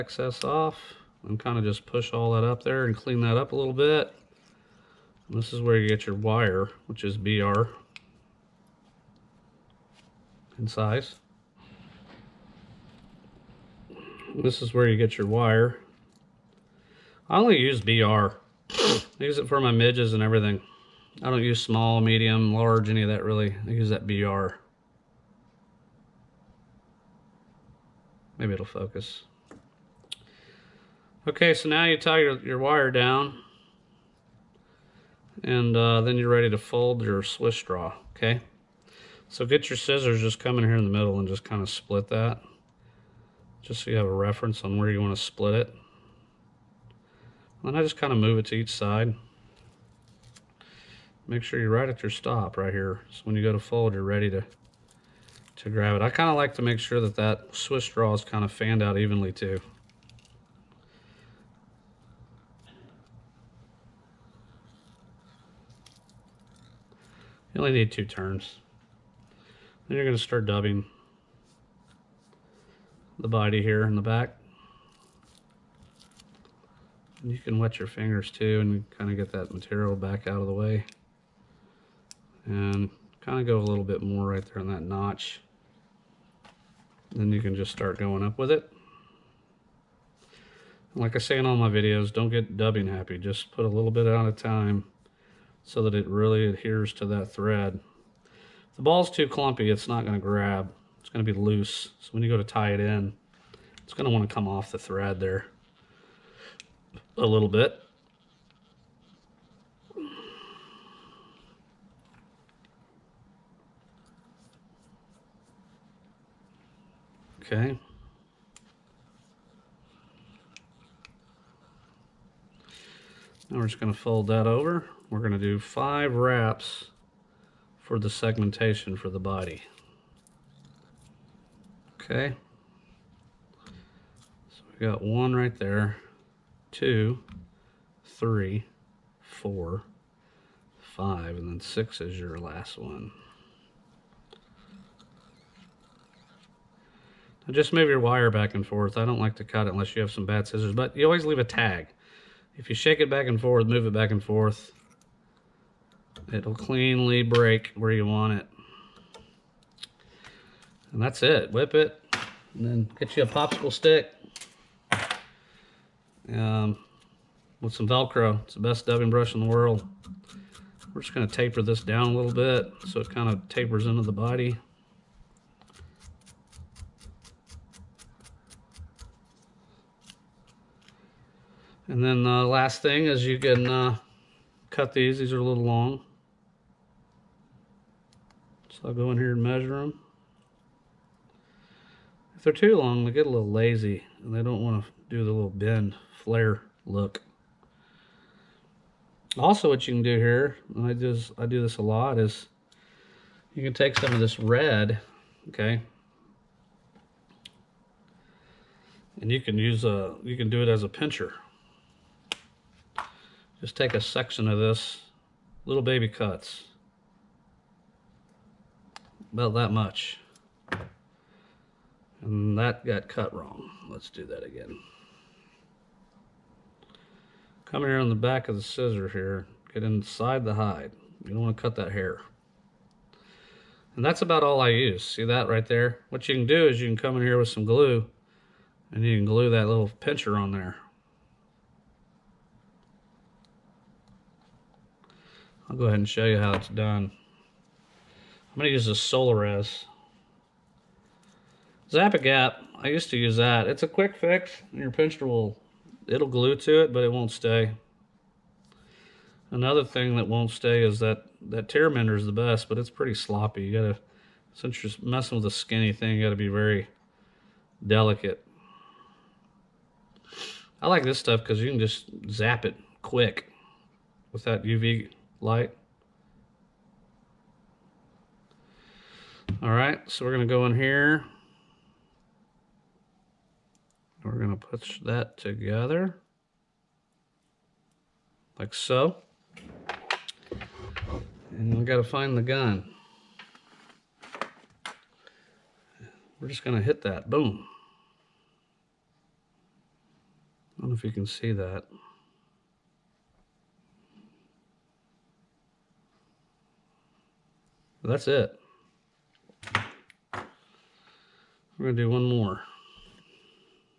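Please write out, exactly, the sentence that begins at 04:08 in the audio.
I'm going to use a Solarez Zap-a-gap.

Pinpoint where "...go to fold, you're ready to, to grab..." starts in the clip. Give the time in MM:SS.
00:53.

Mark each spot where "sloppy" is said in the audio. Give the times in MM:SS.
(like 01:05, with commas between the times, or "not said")
04:23.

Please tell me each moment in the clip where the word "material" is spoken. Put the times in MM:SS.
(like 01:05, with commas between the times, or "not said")
01:19.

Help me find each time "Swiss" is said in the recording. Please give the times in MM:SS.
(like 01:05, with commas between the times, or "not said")
00:37, 00:57.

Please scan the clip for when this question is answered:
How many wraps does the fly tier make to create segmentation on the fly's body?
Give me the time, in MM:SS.
02:05.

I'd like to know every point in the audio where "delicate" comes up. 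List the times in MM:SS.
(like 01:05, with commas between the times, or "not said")
04:27.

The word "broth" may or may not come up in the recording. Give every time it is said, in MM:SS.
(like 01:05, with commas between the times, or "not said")
not said.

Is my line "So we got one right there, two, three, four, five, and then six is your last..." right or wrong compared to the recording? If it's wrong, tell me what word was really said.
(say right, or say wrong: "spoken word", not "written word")
right.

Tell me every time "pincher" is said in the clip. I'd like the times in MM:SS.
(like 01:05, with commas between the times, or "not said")
03:30, 03:59, 04:14.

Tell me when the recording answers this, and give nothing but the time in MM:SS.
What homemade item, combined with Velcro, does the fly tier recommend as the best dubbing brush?
02:43.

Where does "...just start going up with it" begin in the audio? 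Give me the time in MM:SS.
01:27.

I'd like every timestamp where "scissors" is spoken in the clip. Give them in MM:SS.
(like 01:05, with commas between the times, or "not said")
00:39, 02:30, 03:48.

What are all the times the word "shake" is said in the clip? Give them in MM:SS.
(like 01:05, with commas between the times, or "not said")
02:32.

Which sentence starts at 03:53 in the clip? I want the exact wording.
And that's about all I use.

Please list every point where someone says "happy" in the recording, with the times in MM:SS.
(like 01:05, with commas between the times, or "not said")
01:32.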